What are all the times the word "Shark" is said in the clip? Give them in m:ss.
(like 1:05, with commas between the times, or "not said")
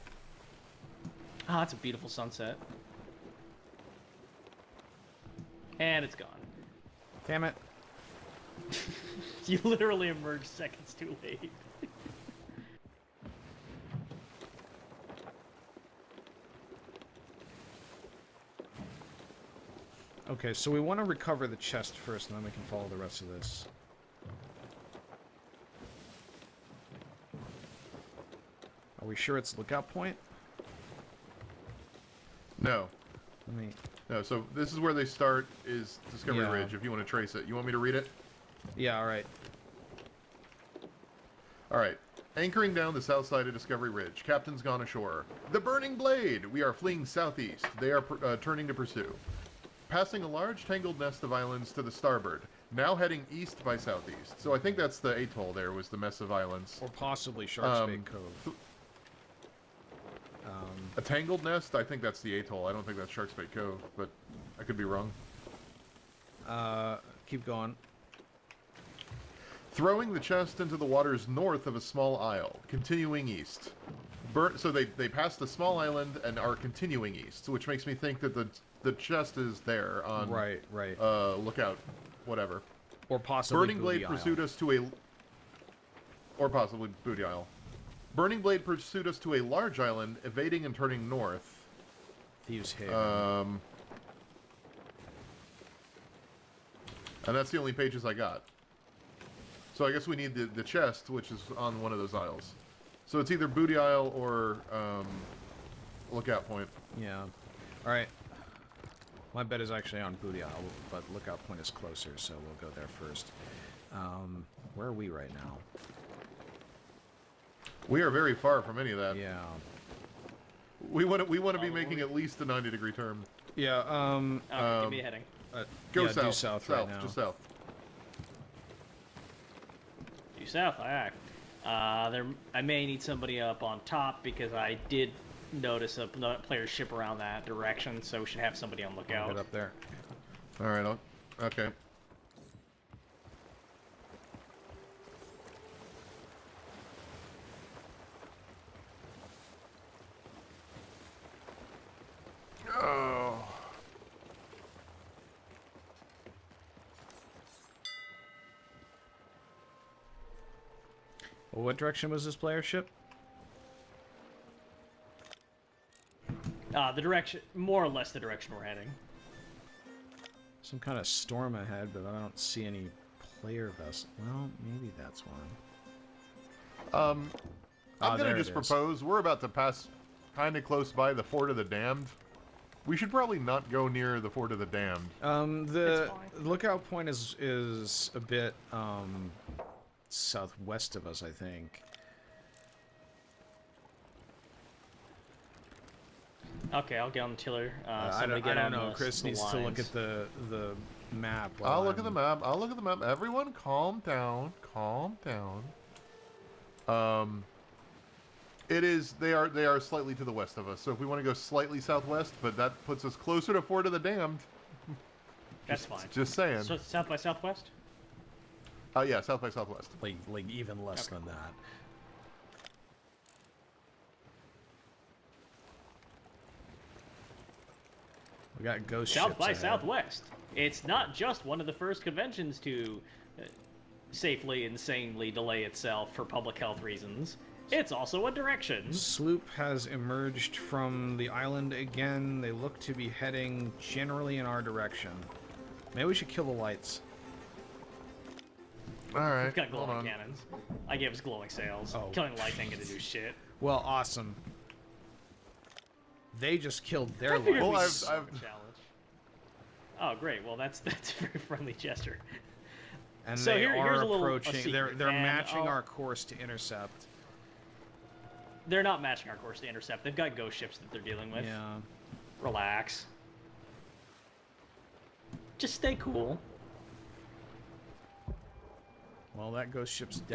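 0:57, 1:03.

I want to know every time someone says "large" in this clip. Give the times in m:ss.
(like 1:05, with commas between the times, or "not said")
0:50, 1:29.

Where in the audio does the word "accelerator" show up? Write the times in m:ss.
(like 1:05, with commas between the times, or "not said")
not said.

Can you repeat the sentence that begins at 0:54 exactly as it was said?
So I think that's the atoll there, was the mess of islands.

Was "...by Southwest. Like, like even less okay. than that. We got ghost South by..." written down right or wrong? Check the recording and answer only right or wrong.
right.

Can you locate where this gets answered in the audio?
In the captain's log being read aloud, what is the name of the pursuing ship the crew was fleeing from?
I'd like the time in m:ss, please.
0:45.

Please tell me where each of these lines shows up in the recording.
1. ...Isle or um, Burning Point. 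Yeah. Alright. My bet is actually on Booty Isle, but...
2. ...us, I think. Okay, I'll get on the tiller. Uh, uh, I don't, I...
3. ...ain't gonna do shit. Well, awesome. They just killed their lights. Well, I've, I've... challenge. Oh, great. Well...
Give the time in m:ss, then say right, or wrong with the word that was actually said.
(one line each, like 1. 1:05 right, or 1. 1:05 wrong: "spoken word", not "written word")
1. 1:43 wrong: "Lookout", not "Burning"
2. 3:11 right
3. 4:12 right.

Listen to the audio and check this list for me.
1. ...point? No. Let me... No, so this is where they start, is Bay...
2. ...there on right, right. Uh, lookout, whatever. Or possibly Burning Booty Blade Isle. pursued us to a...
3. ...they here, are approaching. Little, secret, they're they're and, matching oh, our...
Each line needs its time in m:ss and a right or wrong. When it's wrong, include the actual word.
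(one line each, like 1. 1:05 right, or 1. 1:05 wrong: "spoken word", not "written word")
1. 0:29 wrong: "Discovery", not "Bay"
2. 1:19 right
3. 4:23 right.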